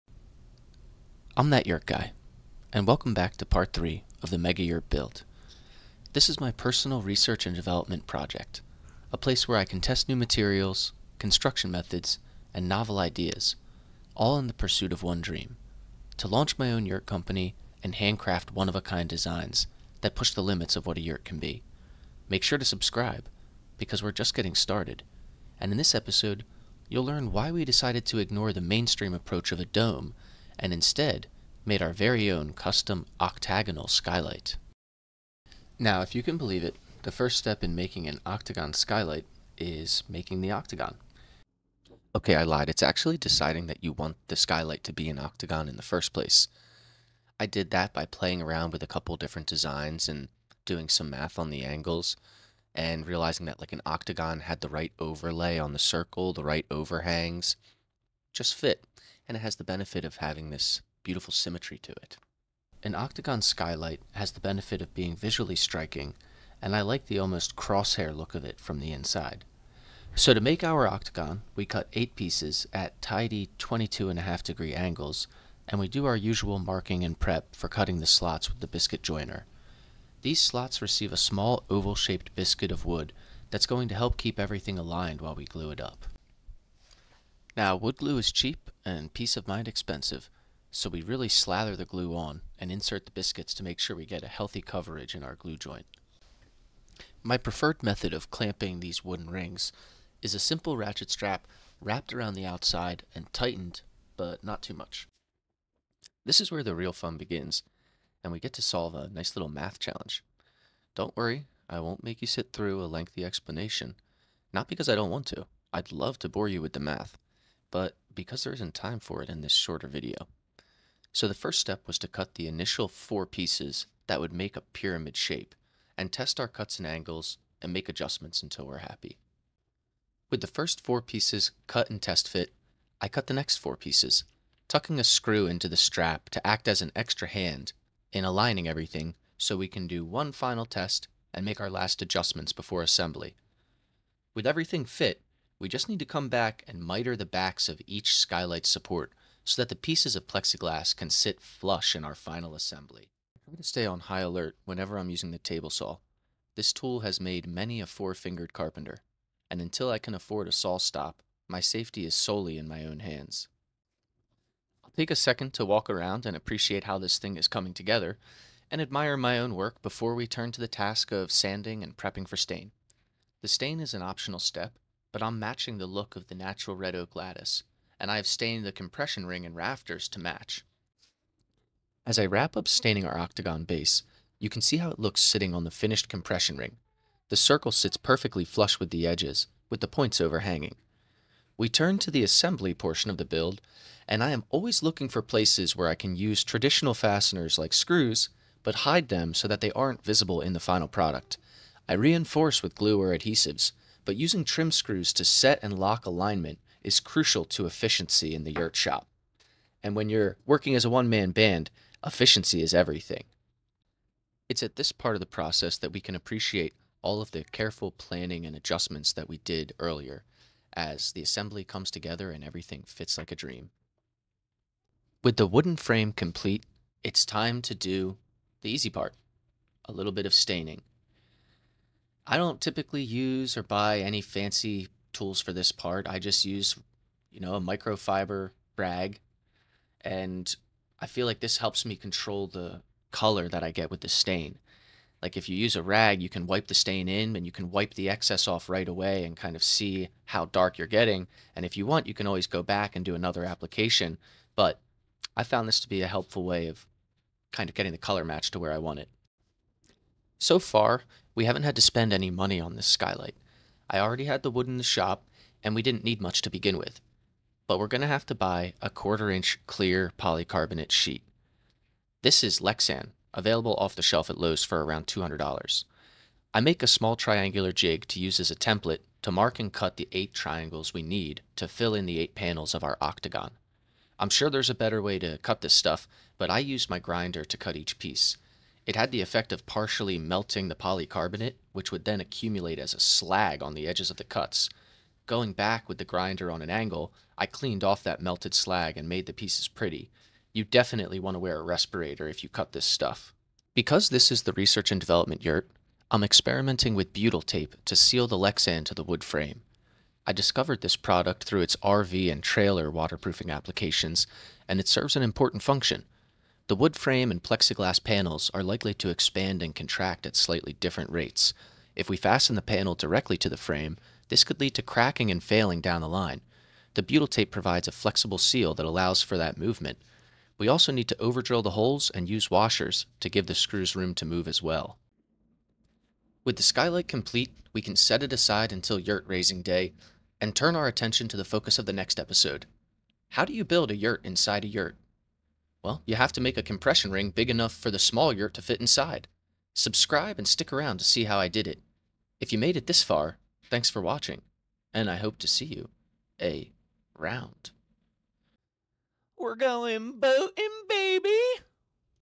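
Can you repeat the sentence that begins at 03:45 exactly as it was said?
With the wooden frame complete, it's time to do the easy part a little bit of staining.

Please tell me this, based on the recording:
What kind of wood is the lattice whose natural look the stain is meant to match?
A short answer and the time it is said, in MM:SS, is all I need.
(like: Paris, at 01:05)
Red oak, at 02:56.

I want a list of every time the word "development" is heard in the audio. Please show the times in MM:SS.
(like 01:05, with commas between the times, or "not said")
00:07, 05:04.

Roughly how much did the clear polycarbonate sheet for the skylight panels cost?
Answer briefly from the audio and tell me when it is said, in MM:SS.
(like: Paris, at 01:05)
$200, at 04:35.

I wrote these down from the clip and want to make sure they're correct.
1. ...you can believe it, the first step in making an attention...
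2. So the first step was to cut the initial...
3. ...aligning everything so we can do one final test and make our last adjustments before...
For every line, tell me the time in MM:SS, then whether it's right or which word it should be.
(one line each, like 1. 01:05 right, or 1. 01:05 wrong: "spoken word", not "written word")
1. 00:36 wrong: "octagon", not "attention"
2. 02:01 right
3. 02:18 right.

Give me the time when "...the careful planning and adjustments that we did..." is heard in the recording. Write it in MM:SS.
03:37.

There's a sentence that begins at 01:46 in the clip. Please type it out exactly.
This is where the real fun begins, and we get to solve a nice little math challenge.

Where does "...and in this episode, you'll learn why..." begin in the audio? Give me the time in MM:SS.
00:25.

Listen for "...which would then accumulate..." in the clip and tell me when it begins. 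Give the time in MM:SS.
04:51.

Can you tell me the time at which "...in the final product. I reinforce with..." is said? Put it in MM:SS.
03:20.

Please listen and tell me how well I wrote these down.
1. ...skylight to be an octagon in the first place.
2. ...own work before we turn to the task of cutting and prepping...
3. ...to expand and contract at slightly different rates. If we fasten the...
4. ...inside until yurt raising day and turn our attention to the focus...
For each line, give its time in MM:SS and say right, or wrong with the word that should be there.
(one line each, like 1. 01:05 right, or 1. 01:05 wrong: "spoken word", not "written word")
1. 00:44 right
2. 02:49 wrong: "sanding", not "cutting"
3. 05:18 right
4. 05:38 wrong: "aside", not "inside".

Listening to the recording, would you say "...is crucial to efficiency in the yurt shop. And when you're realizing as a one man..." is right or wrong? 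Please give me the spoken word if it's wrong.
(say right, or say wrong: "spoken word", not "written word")
wrong: "working", not "realizing".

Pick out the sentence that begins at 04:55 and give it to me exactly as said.
Going back with the grinder on an angle, I cleaned off that melted slag and made the pieces pretty.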